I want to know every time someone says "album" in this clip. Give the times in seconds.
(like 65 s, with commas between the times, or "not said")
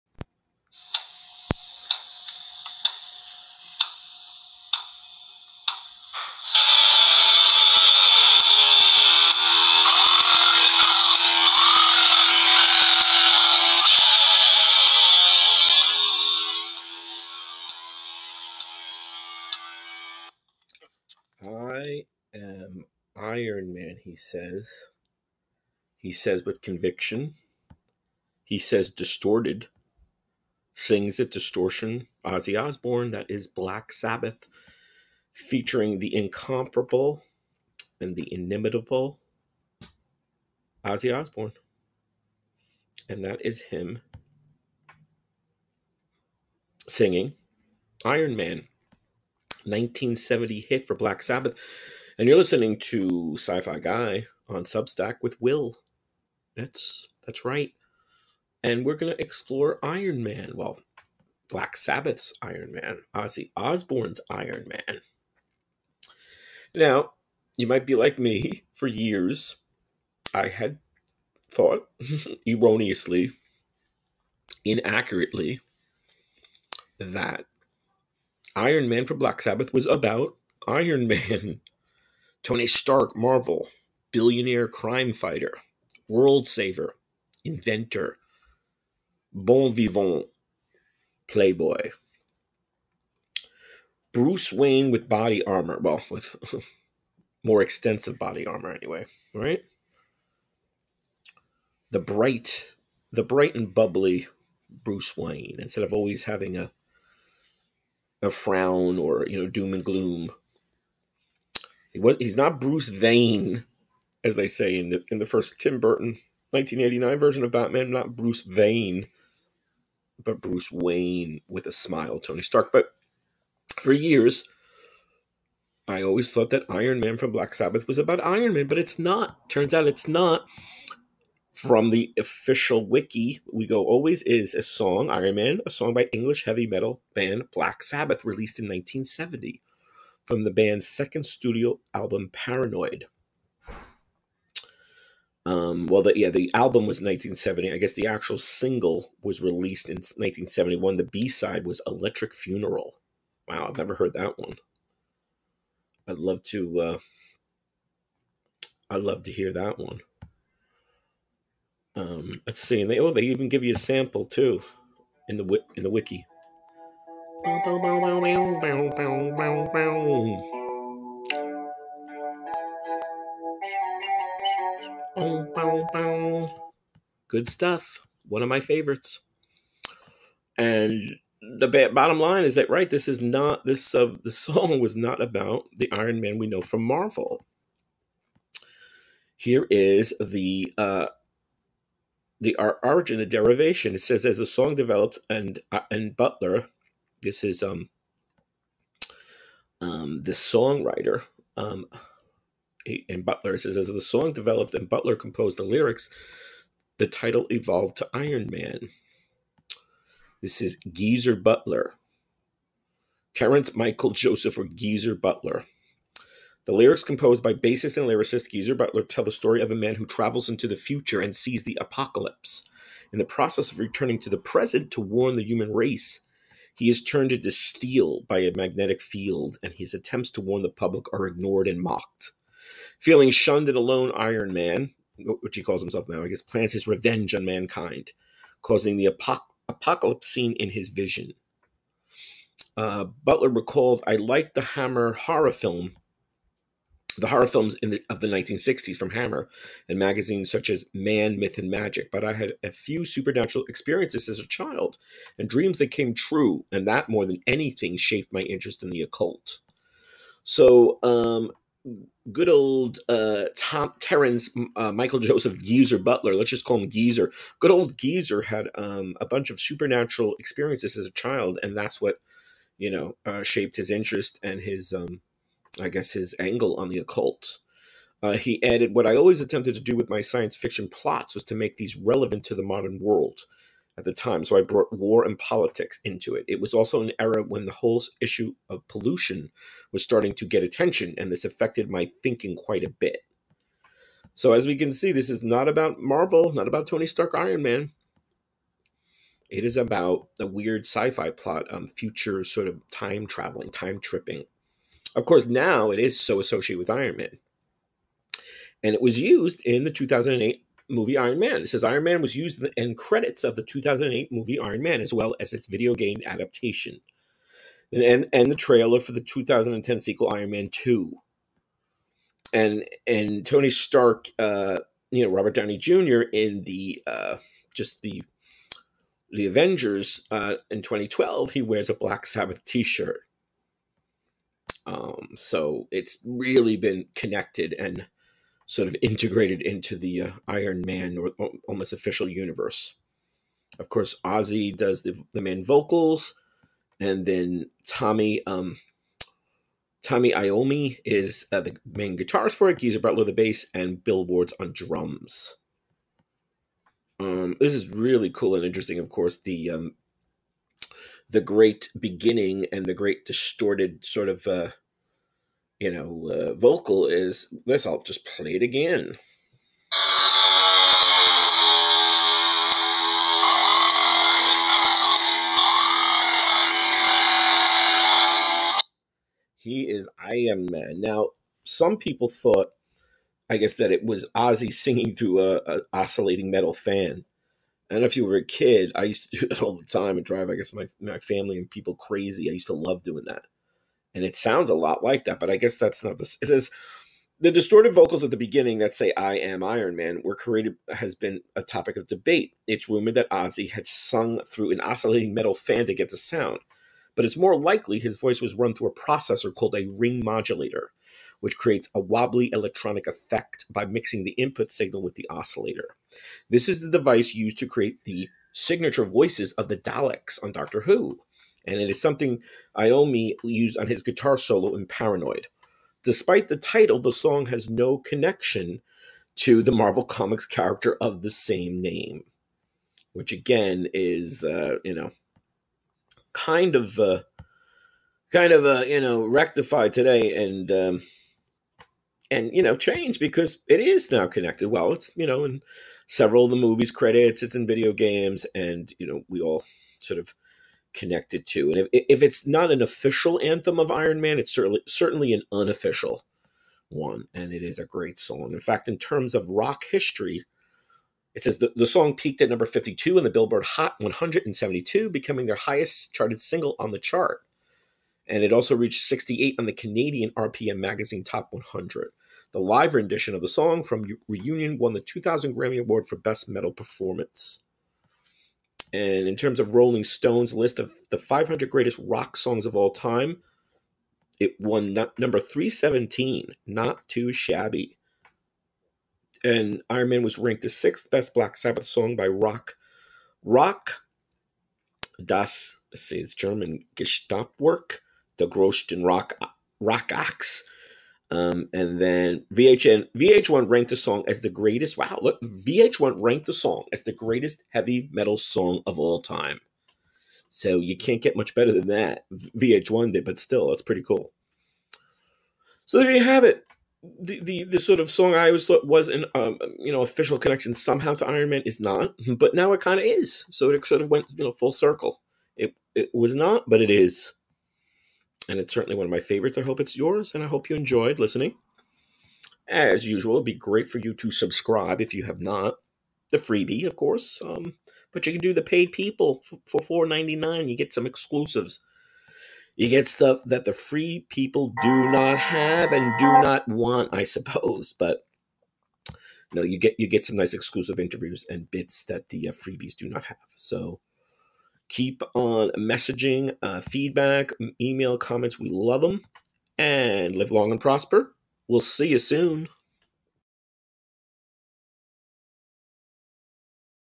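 141 s, 146 s.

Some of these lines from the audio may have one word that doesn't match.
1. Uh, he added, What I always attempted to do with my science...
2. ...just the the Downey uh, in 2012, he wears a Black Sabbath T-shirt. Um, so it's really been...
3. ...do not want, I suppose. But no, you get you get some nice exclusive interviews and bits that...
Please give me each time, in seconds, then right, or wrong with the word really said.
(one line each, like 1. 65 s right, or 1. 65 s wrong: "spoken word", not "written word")
1. 278 s right
2. 327 s wrong: "Avengers", not "Downey"
3. 546 s right.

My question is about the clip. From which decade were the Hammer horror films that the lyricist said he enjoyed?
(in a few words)
1960s.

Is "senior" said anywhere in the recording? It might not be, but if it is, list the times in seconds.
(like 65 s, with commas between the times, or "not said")
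not said.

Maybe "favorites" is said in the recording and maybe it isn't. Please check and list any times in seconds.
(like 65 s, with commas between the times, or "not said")
178 s, 529 s.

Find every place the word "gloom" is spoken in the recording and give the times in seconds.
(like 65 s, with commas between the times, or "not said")
109 s.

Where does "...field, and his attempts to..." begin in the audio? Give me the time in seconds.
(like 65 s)
229 s.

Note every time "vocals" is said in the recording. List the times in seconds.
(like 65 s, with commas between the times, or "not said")
345 s, 366 s, 397 s.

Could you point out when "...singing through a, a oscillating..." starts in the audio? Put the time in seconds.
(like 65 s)
384 s.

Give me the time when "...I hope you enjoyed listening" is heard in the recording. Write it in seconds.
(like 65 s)
530 s.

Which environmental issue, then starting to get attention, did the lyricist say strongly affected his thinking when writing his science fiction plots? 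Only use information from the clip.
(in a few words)
pollution.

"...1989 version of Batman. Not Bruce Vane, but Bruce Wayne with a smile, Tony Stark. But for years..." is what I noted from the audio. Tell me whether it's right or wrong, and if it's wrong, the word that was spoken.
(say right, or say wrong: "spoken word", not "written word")
right.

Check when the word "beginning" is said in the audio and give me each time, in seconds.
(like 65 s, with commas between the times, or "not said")
361 s, 398 s.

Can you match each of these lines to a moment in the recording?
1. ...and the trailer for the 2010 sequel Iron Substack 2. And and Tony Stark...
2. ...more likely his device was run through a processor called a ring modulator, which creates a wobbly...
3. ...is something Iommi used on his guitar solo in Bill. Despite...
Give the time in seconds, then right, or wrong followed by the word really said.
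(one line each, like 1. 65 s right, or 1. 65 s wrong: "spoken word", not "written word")
1. 318 s wrong: "Man", not "Substack"
2. 407 s wrong: "voice", not "device"
3. 421 s wrong: "Paranoid", not "Bill".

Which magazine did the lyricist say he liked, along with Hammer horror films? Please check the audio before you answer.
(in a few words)
Man, Myth, and Magic.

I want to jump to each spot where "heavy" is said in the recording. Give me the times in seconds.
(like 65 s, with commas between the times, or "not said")
136 s, 507 s.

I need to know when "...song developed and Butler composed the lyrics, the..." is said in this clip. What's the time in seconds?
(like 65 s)
204 s.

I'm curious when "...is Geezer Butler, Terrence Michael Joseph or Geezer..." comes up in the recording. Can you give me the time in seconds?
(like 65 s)
210 s.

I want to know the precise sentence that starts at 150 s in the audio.
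The B side was Electric Funeral.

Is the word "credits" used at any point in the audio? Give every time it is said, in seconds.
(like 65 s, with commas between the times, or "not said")
312 s, 446 s.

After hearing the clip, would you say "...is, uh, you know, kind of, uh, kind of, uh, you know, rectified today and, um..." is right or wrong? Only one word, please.
right.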